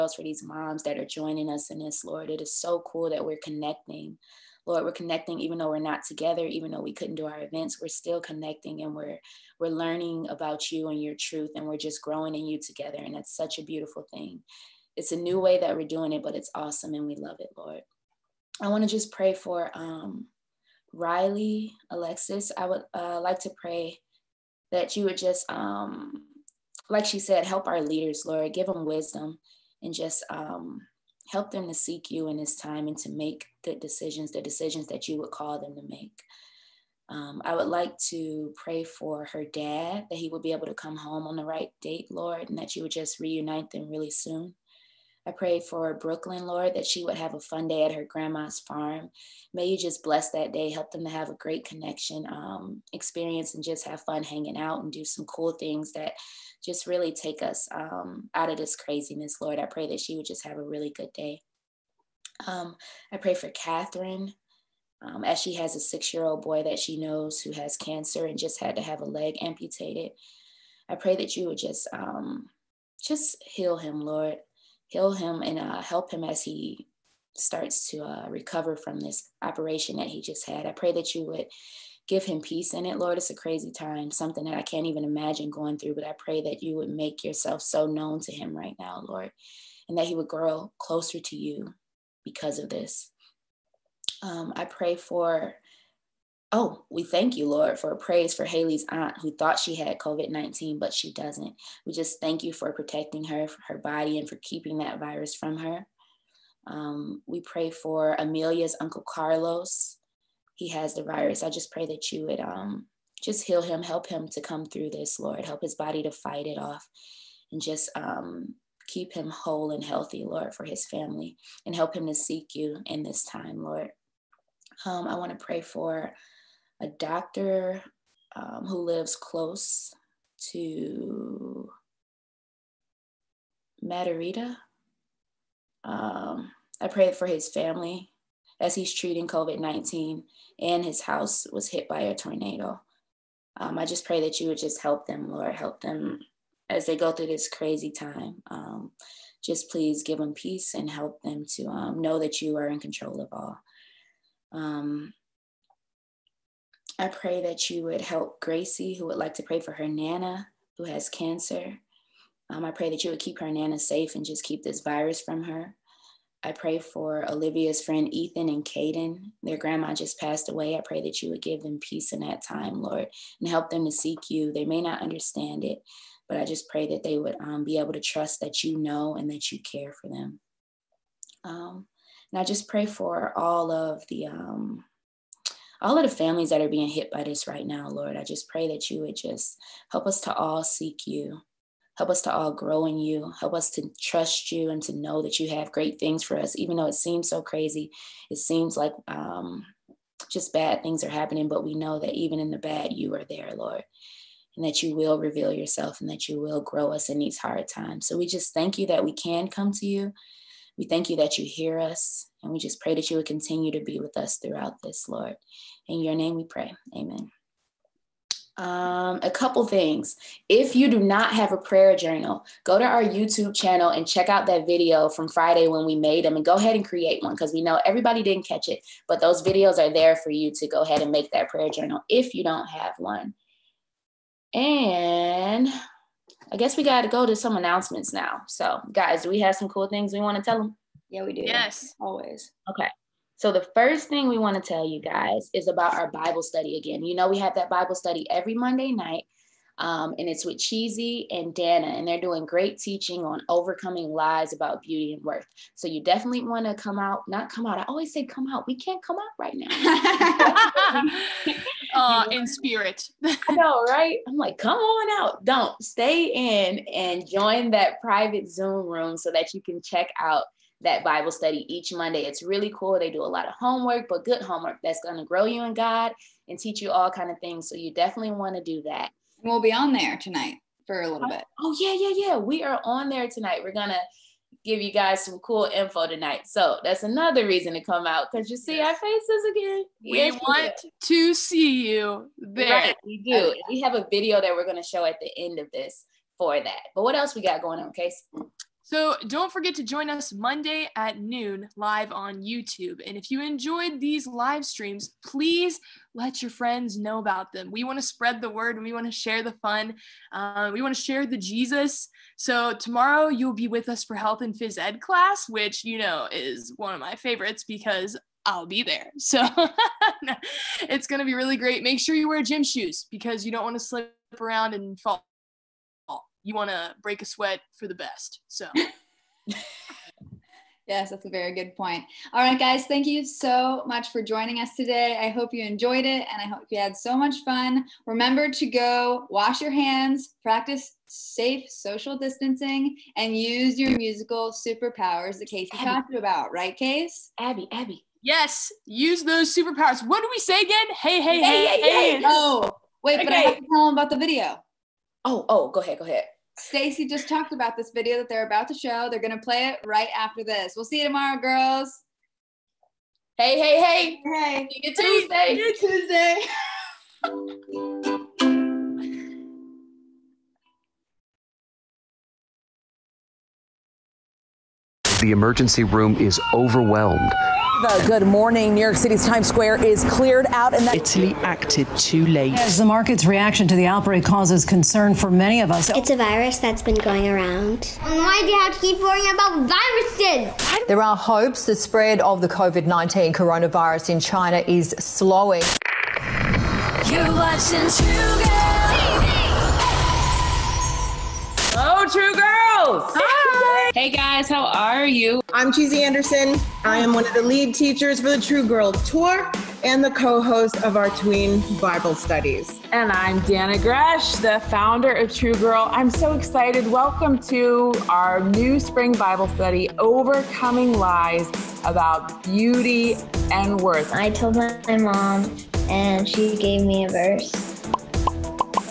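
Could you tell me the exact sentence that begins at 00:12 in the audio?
And that's such a beautiful thing.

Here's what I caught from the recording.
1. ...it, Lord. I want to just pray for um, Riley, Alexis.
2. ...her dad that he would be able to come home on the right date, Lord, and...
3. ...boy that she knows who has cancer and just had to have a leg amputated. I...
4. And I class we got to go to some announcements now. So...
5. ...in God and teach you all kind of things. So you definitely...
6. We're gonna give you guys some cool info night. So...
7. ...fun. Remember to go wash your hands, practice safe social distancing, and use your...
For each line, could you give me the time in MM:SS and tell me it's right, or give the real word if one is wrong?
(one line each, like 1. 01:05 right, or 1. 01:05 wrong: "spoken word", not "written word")
1. 00:17 right
2. 00:39 right
3. 01:06 right
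4. 03:54 wrong: "guess", not "class"
5. 04:35 right
6. 04:43 wrong: "tonight", not "night"
7. 05:37 right.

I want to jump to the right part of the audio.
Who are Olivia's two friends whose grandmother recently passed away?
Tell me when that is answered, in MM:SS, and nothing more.
02:48.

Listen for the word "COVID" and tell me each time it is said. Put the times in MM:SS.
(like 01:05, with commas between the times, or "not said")
01:39, 02:19, 06:32.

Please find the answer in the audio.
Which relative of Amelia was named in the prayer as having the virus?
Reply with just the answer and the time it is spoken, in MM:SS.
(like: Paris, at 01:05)
Uncle Carlos, at 01:48.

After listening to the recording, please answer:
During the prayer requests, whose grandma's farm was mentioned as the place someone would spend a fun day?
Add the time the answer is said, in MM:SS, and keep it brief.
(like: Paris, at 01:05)
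Brooklyn, at 00:45.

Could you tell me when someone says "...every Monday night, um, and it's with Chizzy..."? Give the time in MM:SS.
04:08.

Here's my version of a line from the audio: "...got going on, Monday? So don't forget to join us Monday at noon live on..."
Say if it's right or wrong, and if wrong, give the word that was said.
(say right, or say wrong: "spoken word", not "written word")
wrong: "Case", not "Monday".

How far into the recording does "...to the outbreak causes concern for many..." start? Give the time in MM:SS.
06:23.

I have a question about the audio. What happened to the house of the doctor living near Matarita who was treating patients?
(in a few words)
Hit by a tornado.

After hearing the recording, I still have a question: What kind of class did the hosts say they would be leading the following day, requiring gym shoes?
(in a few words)
Health and Phys Ed.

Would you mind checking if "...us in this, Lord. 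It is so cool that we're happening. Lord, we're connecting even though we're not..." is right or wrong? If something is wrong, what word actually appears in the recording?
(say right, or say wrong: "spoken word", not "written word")
wrong: "connecting", not "happening".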